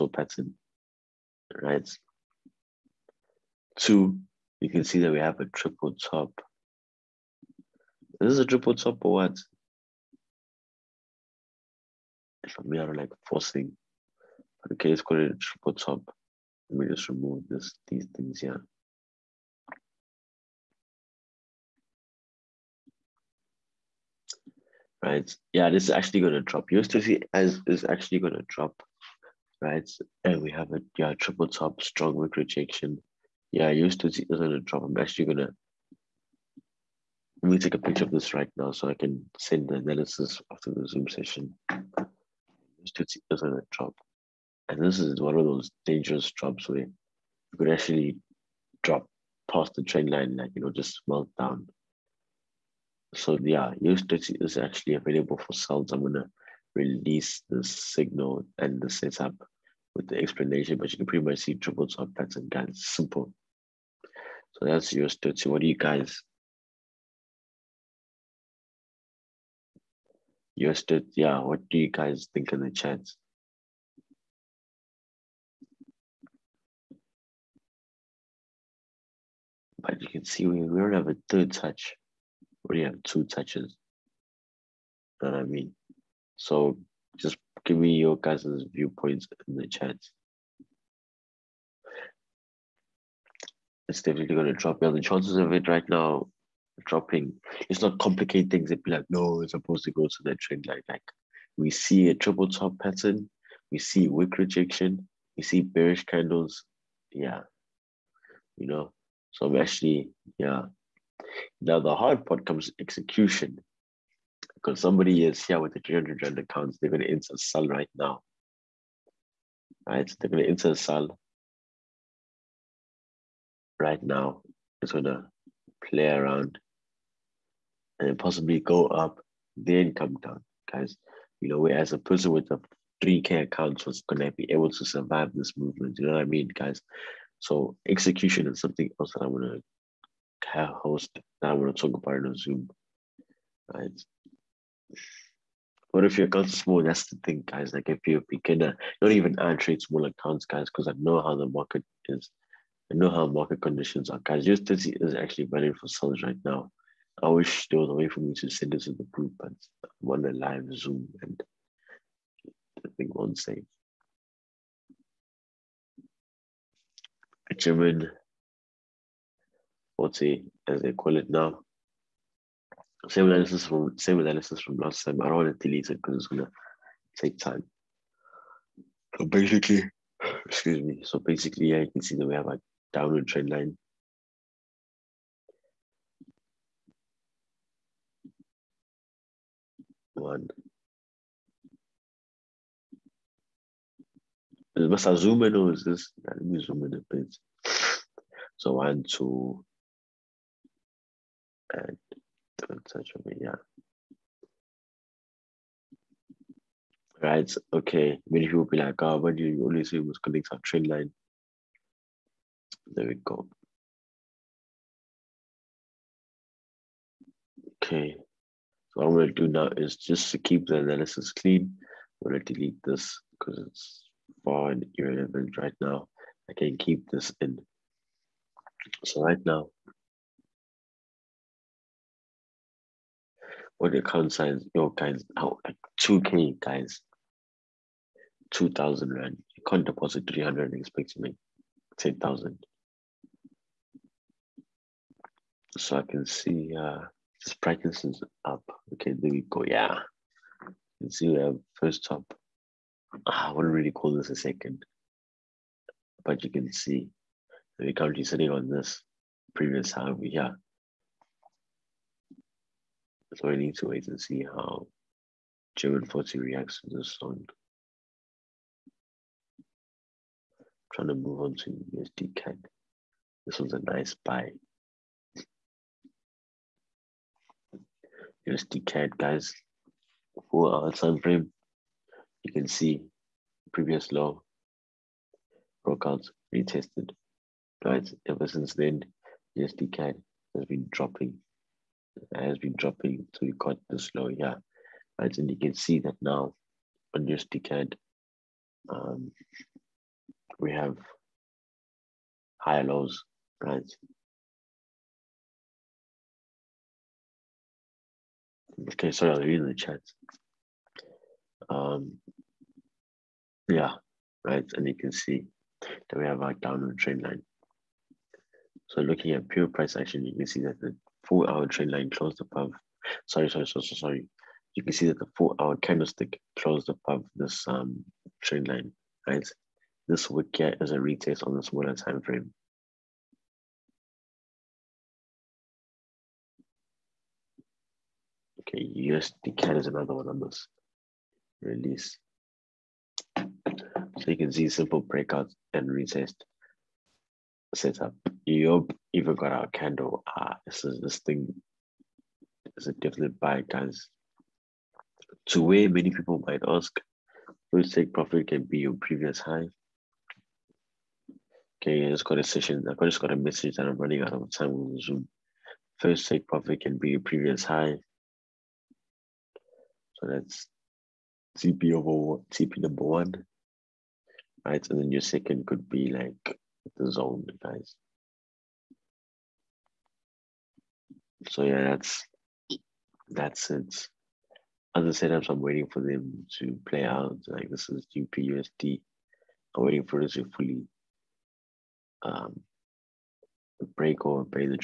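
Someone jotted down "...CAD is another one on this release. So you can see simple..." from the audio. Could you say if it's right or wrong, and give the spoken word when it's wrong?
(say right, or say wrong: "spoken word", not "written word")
right.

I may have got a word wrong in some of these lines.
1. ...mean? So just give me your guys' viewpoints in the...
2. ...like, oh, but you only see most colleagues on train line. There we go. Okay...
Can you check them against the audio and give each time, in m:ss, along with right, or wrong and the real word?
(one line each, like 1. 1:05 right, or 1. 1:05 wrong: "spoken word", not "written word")
1. 1:25 right
2. 3:28 right.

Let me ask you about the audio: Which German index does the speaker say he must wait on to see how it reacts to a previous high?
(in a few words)
German 40.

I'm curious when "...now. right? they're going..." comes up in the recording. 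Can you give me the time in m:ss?
1:57.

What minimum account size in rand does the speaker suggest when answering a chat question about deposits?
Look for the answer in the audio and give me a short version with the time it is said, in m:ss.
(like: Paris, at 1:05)
2,000 rand, at 3:58.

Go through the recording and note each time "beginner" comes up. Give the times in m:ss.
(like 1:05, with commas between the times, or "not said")
2:28.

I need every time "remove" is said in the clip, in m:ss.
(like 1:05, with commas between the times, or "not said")
0:17.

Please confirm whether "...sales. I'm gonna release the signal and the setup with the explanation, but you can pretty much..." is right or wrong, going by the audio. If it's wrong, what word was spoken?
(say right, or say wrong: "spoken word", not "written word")
right.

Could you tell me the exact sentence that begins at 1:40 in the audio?
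Like we see a triple top pattern, we see wick rejection, we see bearish candles.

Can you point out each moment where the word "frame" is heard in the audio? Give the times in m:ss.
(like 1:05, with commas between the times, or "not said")
4:41, 5:32.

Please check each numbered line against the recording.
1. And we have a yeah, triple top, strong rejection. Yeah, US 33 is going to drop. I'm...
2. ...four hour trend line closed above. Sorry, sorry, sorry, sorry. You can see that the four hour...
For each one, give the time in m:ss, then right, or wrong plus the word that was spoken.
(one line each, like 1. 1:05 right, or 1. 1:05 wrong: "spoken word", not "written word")
1. 0:30 wrong: "30", not "33"
2. 5:21 right.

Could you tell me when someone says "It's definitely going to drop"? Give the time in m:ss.
1:33.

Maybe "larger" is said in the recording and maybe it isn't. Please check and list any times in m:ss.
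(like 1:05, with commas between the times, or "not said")
not said.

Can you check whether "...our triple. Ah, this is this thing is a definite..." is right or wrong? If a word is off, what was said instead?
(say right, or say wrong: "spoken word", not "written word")
wrong: "candle", not "triple".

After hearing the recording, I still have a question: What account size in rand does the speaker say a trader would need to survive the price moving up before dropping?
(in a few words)
3K.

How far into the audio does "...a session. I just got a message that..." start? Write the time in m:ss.
6:02.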